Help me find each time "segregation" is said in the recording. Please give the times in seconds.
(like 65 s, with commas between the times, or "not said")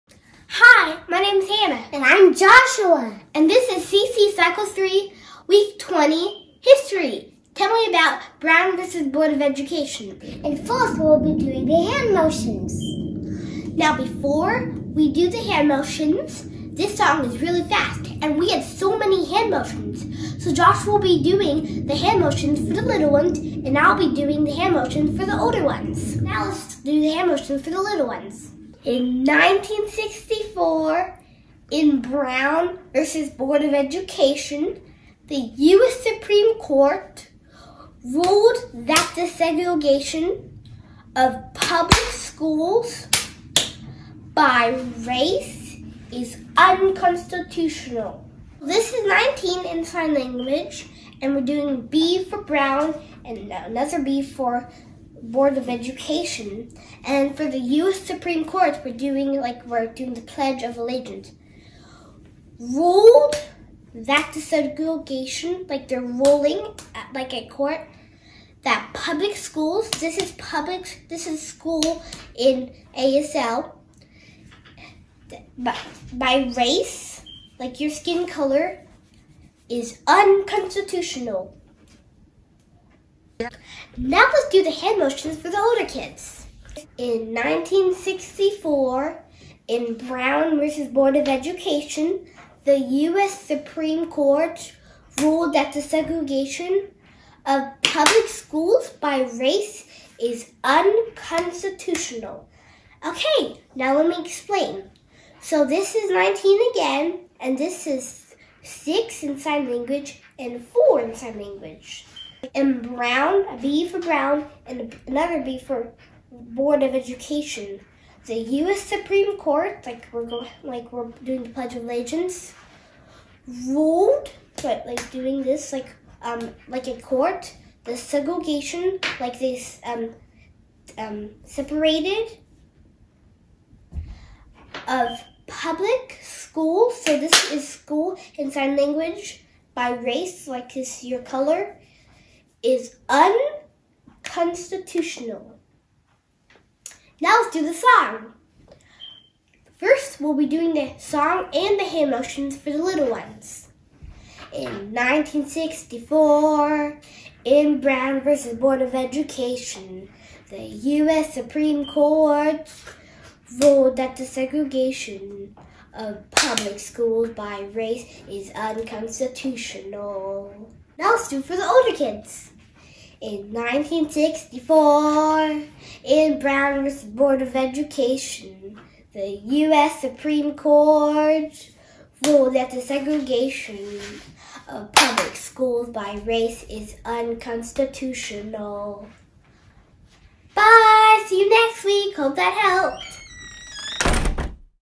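39 s, 64 s, 95 s, 127 s, 164 s, 182 s.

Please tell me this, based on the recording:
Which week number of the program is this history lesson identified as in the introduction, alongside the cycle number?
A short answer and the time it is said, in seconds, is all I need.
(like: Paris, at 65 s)
Week 20, at 5 s.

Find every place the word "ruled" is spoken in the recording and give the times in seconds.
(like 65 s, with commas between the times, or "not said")
38 s, 62 s, 95 s, 123 s, 163 s, 182 s.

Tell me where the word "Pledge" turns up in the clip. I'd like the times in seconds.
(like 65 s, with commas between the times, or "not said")
60 s, 121 s.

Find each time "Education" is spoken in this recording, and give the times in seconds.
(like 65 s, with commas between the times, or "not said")
9 s, 33 s, 55 s, 91 s, 116 s, 158 s, 177 s.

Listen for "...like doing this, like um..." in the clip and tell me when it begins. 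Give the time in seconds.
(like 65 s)
124 s.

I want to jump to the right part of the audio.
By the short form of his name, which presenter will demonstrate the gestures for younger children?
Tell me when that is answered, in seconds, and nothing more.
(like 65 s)
20 s.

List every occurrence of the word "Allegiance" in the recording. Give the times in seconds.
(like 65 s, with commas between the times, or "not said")
60 s, 121 s.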